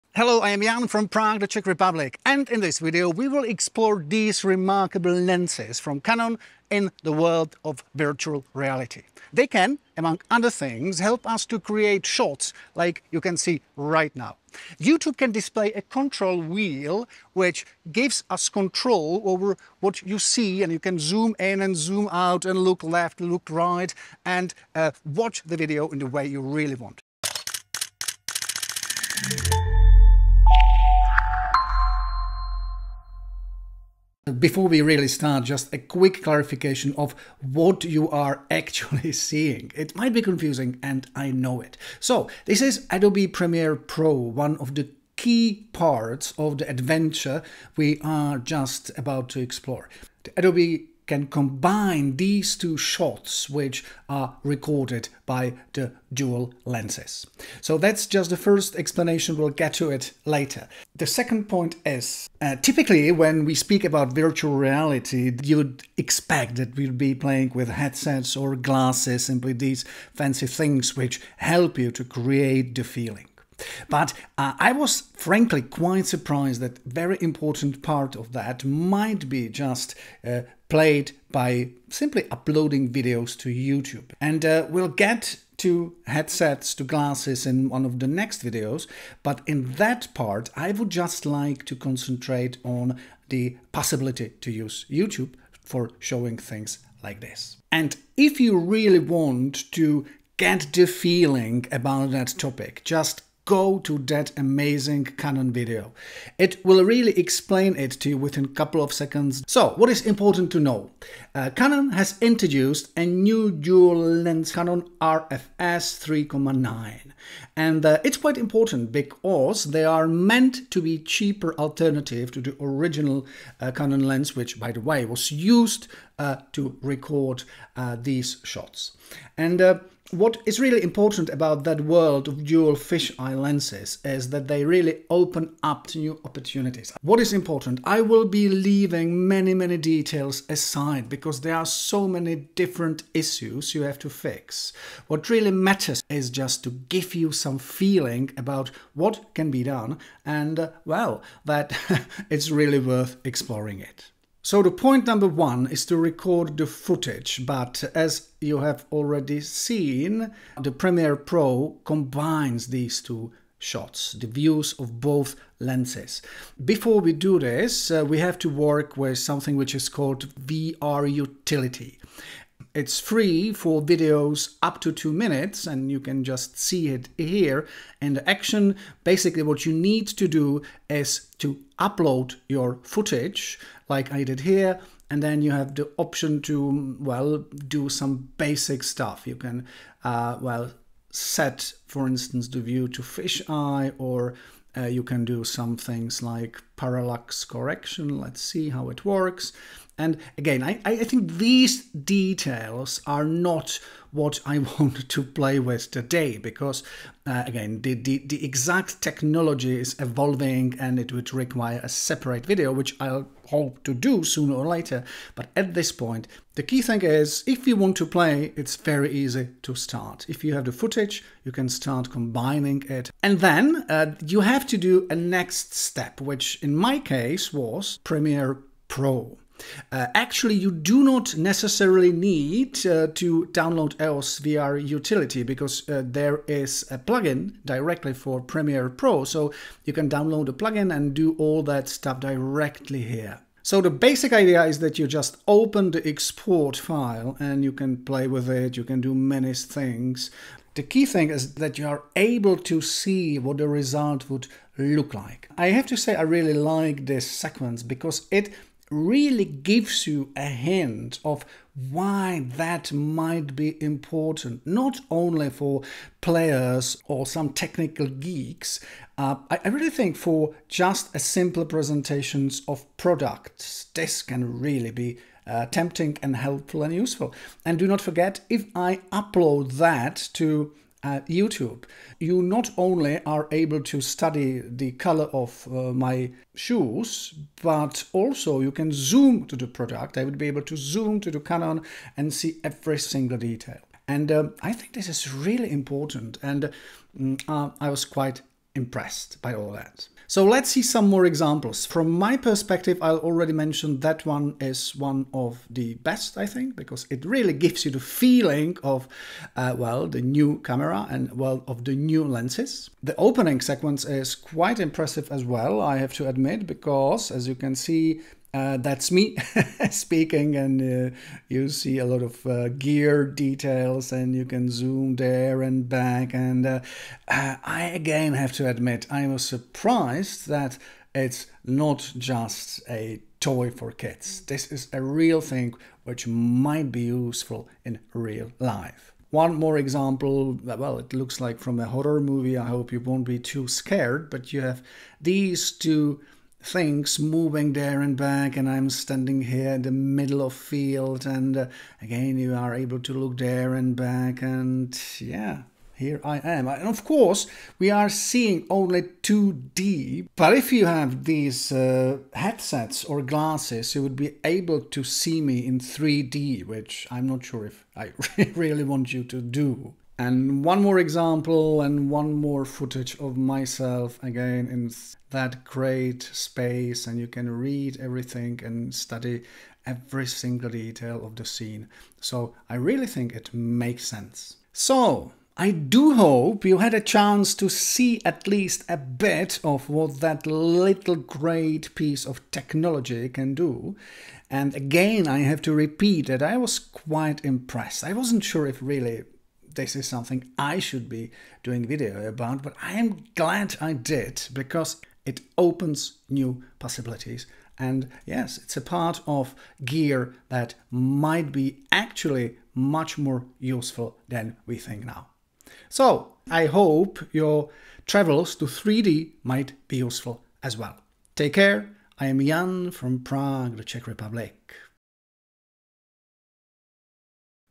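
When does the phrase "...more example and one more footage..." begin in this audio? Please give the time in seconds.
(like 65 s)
370 s.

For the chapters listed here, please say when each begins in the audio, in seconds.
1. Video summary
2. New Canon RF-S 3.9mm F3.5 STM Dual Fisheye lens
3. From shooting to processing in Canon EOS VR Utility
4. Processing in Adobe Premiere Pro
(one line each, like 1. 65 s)
1. 34 s
2. 110 s
3. 154 s
4. 223 s.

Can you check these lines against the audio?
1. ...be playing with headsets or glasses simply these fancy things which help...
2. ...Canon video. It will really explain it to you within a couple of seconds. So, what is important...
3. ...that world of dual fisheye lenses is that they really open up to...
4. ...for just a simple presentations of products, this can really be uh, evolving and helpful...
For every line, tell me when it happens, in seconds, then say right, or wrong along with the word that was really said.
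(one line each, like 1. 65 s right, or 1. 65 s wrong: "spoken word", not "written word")
1. 66 s right
2. 105 s right
3. 131 s right
4. 270 s wrong: "tempting", not "evolving".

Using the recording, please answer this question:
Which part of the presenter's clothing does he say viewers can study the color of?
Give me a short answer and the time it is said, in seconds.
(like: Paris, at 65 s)
Shoes, at 286 s.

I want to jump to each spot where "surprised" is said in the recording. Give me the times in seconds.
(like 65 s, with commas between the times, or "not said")
76 s, 329 s.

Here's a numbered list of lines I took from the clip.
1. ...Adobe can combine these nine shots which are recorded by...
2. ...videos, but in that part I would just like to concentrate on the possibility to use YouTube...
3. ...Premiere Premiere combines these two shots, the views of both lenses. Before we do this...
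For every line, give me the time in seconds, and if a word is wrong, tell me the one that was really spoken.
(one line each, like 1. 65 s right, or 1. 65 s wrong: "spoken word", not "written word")
1. 50 s wrong: "two", not "nine"
2. 88 s right
3. 160 s wrong: "Pro", not "Premiere".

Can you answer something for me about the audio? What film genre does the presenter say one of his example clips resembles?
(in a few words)
Horror movie.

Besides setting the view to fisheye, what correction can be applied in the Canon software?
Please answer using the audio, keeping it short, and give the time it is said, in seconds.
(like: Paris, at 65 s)
Parallax correction, at 196 s.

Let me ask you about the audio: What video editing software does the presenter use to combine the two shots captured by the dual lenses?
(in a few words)
Adobe Premiere Pro.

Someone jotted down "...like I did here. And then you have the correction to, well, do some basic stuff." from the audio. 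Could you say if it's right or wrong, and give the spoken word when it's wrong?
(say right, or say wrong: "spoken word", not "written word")
wrong: "option", not "correction".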